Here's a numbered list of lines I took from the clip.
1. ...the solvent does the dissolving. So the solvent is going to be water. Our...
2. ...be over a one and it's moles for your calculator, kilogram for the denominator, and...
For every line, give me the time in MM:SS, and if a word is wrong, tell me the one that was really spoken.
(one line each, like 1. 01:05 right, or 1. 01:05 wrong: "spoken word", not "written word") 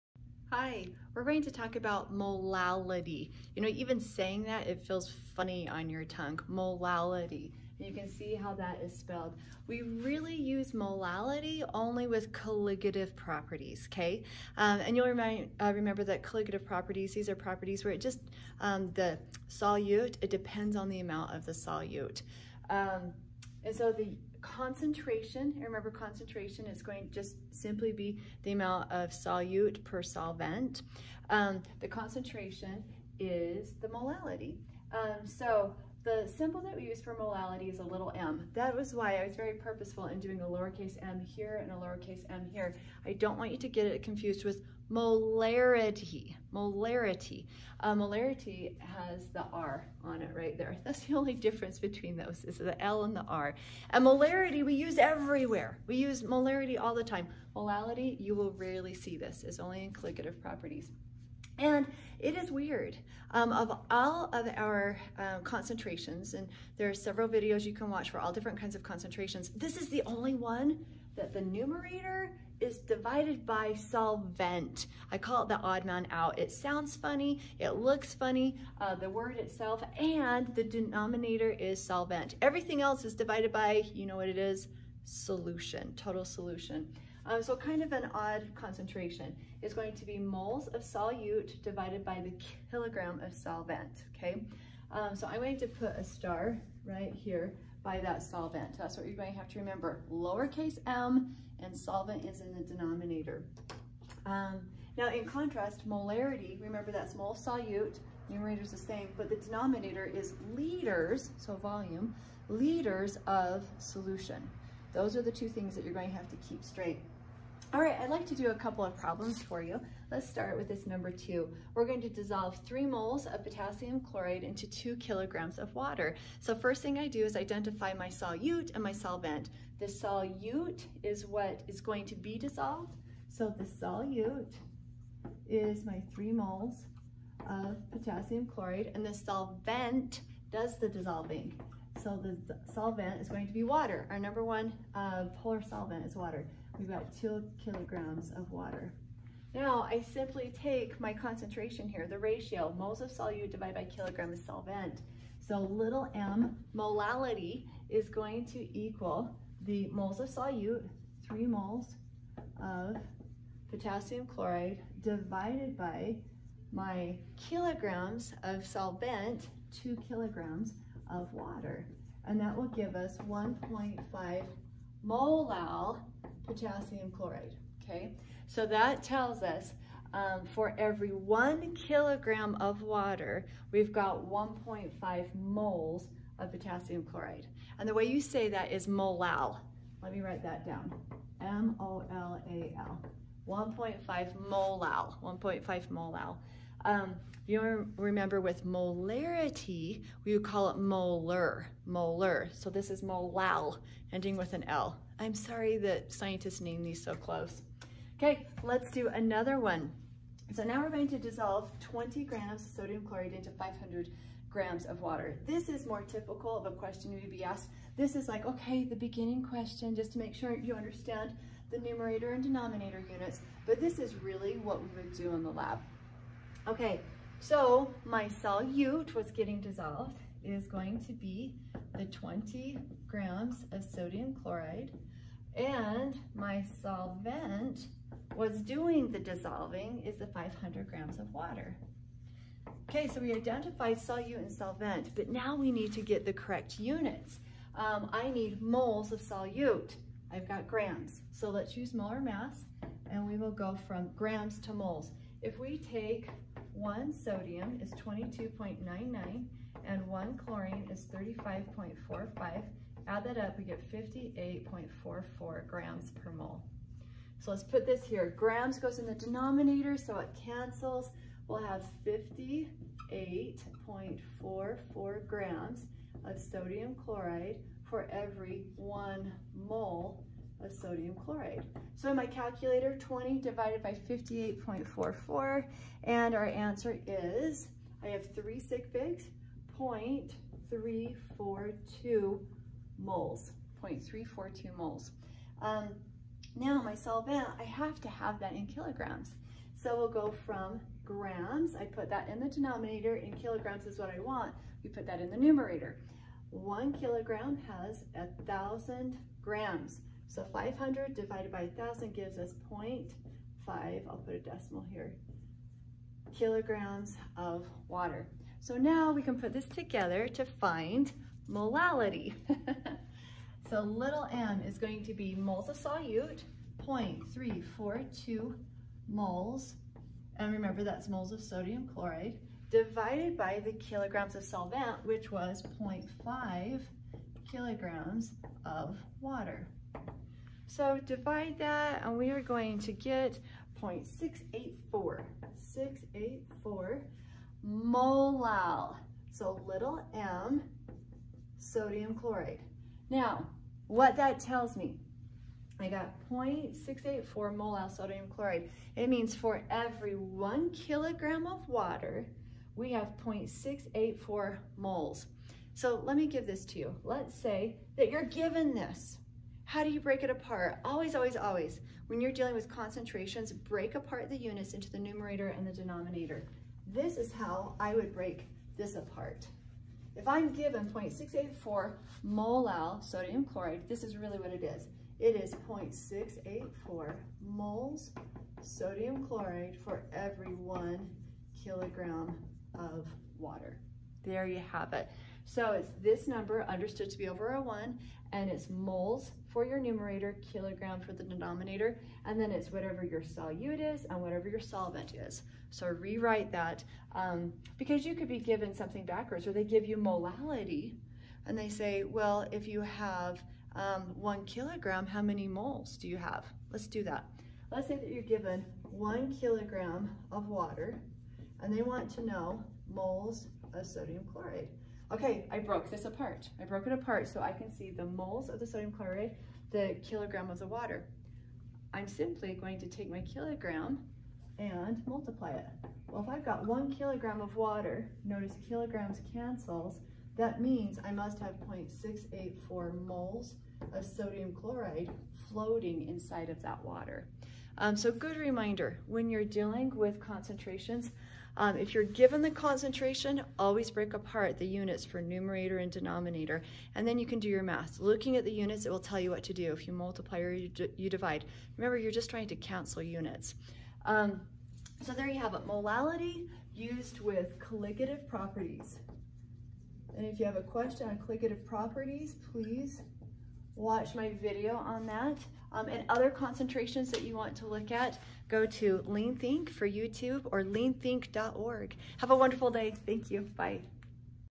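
1. 02:19 right
2. 06:37 wrong: "numerator", not "calculator".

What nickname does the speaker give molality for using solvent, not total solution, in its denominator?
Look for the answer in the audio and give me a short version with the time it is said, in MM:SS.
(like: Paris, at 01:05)
the odd man out, at 01:15.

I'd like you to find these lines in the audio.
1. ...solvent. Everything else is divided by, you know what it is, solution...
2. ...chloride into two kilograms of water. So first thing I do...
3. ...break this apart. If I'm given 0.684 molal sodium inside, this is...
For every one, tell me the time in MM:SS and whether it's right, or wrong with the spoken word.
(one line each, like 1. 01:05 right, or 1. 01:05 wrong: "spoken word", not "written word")
1. 01:21 right
2. 02:04 right
3. 06:18 wrong: "chloride", not "inside".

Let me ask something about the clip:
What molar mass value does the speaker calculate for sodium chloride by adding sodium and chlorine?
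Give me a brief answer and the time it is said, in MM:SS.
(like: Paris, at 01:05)
58.44 grams per mole, at 04:23.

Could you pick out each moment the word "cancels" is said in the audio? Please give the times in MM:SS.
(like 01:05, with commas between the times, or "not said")
04:30, 07:19, 07:42.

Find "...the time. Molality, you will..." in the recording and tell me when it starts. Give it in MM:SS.
00:56.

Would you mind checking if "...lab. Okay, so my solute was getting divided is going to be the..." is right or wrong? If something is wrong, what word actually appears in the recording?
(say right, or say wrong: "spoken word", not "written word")
wrong: "dissolved", not "divided".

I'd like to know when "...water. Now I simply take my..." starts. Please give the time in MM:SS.
02:28.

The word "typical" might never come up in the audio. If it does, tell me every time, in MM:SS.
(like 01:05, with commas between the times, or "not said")
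03:36.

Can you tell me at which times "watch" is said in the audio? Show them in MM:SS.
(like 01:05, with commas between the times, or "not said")
01:07, 07:53.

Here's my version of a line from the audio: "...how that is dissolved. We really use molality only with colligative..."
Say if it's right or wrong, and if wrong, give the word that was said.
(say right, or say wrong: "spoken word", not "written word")
wrong: "spelled", not "dissolved".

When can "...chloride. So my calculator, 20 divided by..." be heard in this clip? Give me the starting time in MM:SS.
04:41.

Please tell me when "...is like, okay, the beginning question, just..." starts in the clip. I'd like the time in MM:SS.
03:38.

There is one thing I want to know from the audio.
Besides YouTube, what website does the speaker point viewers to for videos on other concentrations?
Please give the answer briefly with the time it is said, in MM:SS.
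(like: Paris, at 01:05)
leanthink.org, at 08:00.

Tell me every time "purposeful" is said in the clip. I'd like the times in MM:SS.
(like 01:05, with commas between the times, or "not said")
00:39.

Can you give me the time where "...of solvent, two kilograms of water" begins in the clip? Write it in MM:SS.
02:48.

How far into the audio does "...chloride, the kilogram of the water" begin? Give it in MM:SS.
07:08.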